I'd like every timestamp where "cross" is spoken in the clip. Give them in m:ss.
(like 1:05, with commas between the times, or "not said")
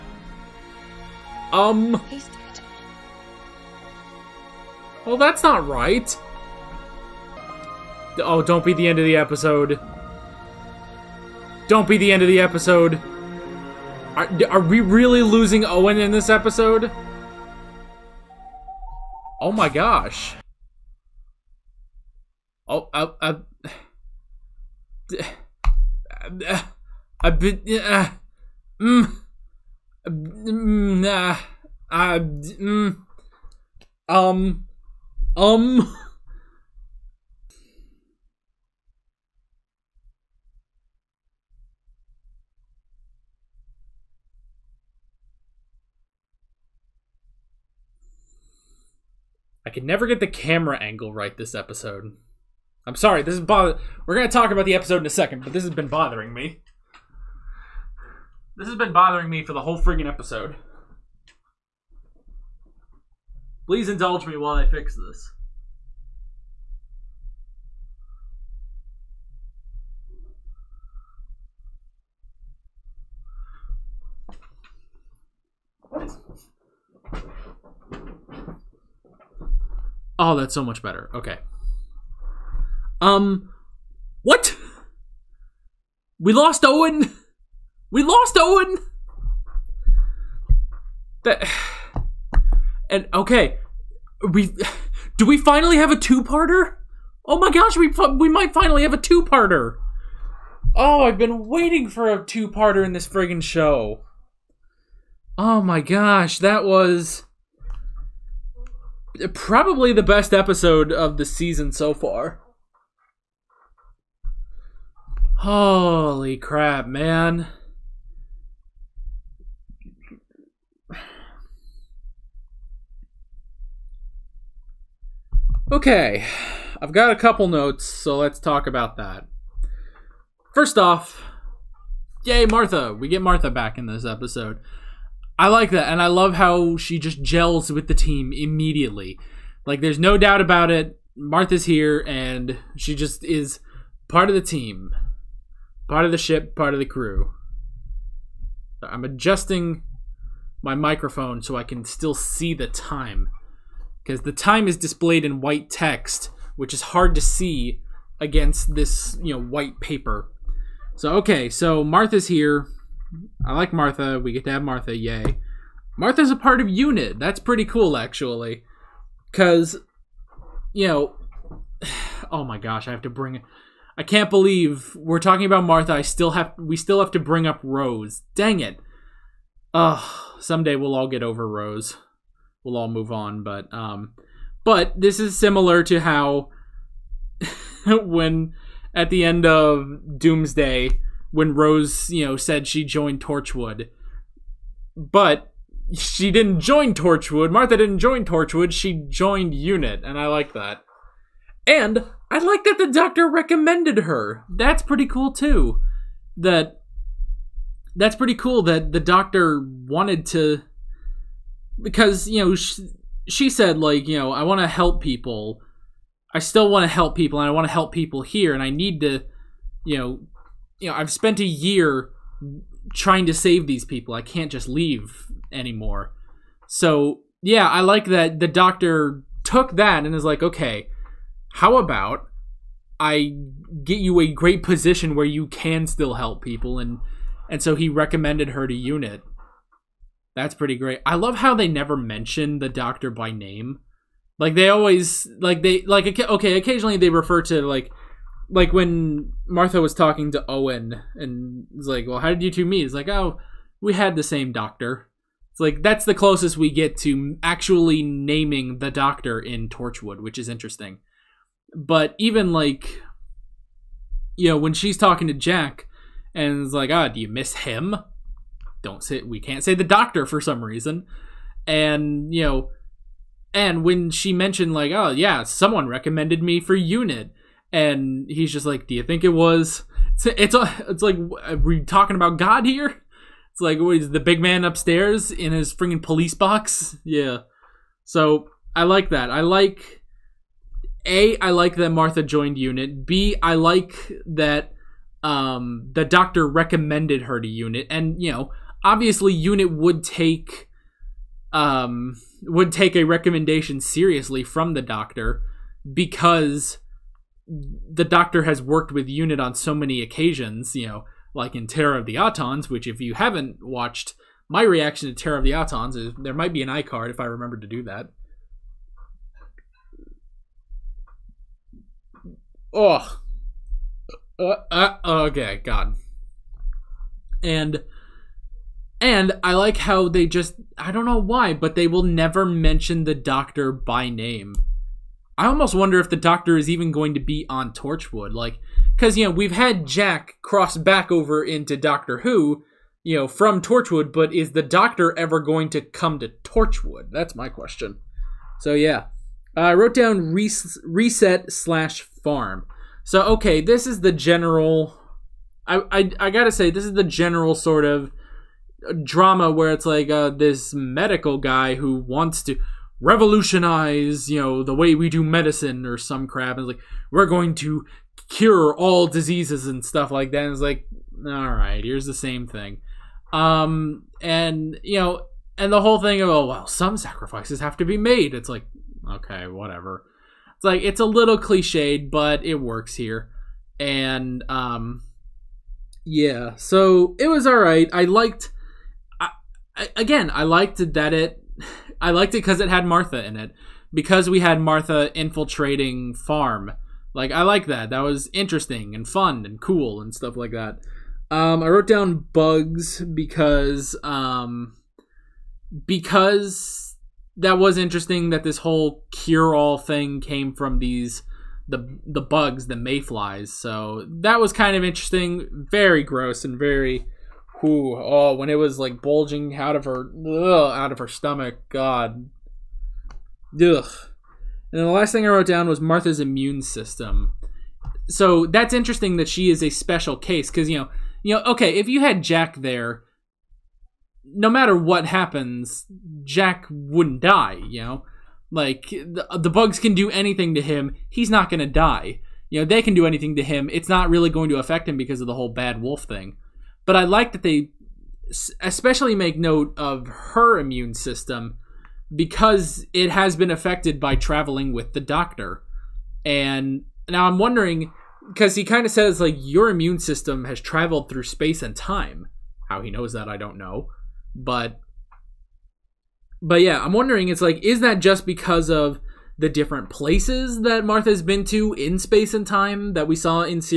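5:40.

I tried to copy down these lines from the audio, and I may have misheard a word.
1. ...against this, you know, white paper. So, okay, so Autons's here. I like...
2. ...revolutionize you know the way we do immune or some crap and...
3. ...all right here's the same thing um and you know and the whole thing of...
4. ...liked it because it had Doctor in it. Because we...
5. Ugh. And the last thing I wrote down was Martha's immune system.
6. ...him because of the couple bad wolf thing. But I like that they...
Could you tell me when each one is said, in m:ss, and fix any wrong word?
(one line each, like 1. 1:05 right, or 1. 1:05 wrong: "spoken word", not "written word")
1. 2:38 wrong: "Martha", not "Autons"
2. 6:03 wrong: "medicine", not "immune"
3. 6:11 right
4. 6:32 wrong: "Martha", not "Doctor"
5. 7:03 right
6. 7:24 wrong: "whole", not "couple".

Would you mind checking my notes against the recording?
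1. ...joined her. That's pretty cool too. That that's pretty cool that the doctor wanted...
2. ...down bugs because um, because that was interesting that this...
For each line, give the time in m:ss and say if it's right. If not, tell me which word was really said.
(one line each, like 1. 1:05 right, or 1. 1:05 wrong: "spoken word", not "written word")
1. 3:23 wrong: "recommended", not "joined"
2. 6:41 right.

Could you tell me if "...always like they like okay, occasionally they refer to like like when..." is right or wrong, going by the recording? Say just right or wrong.
right.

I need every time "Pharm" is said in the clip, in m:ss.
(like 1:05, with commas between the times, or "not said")
5:52, 6:36.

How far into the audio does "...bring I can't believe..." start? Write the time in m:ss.
2:53.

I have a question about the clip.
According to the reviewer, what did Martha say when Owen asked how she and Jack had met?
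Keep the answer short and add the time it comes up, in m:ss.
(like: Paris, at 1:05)
We had the same doctor, at 4:13.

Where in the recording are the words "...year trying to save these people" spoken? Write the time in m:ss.
3:41.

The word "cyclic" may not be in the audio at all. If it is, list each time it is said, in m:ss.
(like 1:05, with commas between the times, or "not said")
not said.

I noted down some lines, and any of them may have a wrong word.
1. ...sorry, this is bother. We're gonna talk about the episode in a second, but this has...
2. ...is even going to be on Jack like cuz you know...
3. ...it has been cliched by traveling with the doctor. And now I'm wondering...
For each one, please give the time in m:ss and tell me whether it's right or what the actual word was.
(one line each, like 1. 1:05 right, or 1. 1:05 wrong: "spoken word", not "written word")
1. 0:52 right
2. 5:36 wrong: "Torchwood", not "Jack"
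3. 7:32 wrong: "affected", not "cliched".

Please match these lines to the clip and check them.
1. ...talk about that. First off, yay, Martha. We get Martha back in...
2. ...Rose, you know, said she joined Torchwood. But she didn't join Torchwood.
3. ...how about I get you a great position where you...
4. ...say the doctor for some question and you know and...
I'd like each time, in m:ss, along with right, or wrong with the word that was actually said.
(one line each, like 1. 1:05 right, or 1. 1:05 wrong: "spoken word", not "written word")
1. 2:08 right
2. 3:11 right
3. 3:51 right
4. 4:29 wrong: "reason", not "question".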